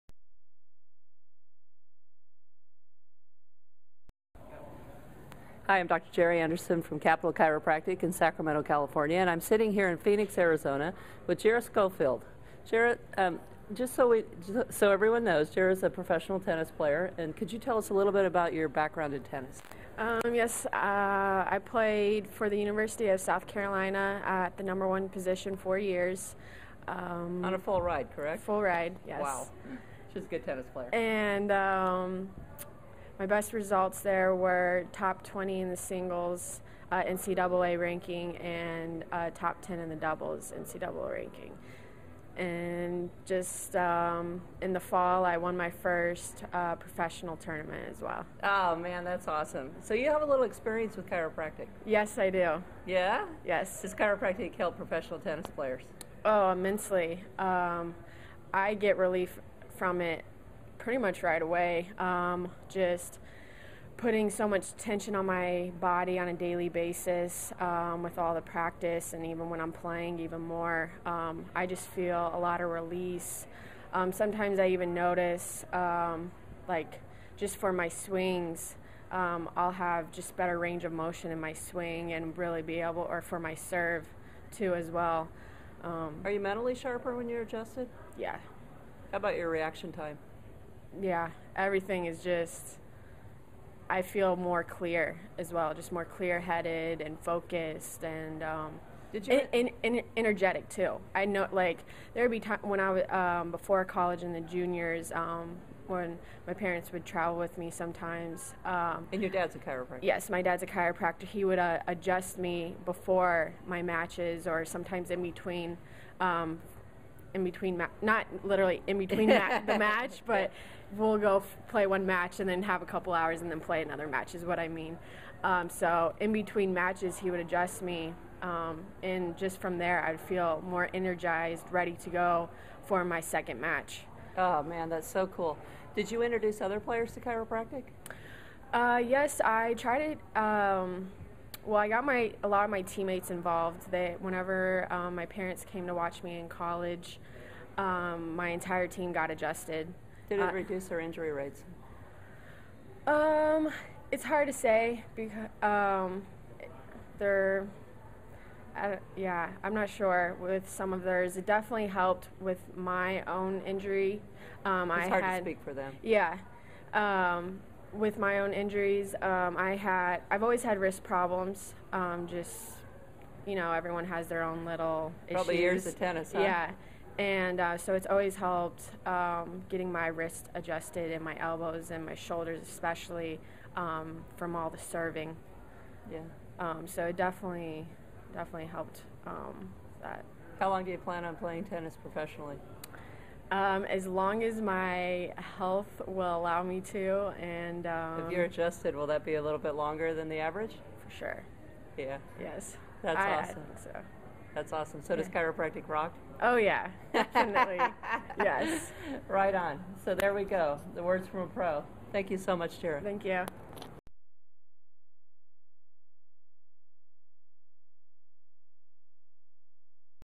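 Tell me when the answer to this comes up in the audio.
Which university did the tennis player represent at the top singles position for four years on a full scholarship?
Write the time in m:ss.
0:22.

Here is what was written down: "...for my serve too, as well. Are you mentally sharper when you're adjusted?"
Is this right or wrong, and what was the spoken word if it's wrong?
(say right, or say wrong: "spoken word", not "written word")
right.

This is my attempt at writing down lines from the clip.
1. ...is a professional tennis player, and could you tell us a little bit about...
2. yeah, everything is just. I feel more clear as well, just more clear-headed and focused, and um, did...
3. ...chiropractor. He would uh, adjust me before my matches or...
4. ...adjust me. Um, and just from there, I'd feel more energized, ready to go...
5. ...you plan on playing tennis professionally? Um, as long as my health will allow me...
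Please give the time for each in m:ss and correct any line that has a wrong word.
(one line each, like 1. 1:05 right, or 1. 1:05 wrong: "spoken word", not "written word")
1. 0:15 right
2. 1:30 right
3. 1:50 right
4. 2:07 right
5. 3:10 right.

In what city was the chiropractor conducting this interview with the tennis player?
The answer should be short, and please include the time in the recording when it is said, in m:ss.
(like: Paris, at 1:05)
Phoenix, at 0:09.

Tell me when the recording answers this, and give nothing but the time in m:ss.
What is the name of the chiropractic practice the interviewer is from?
0:06.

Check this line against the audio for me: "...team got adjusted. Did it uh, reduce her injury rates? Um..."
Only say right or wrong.
right.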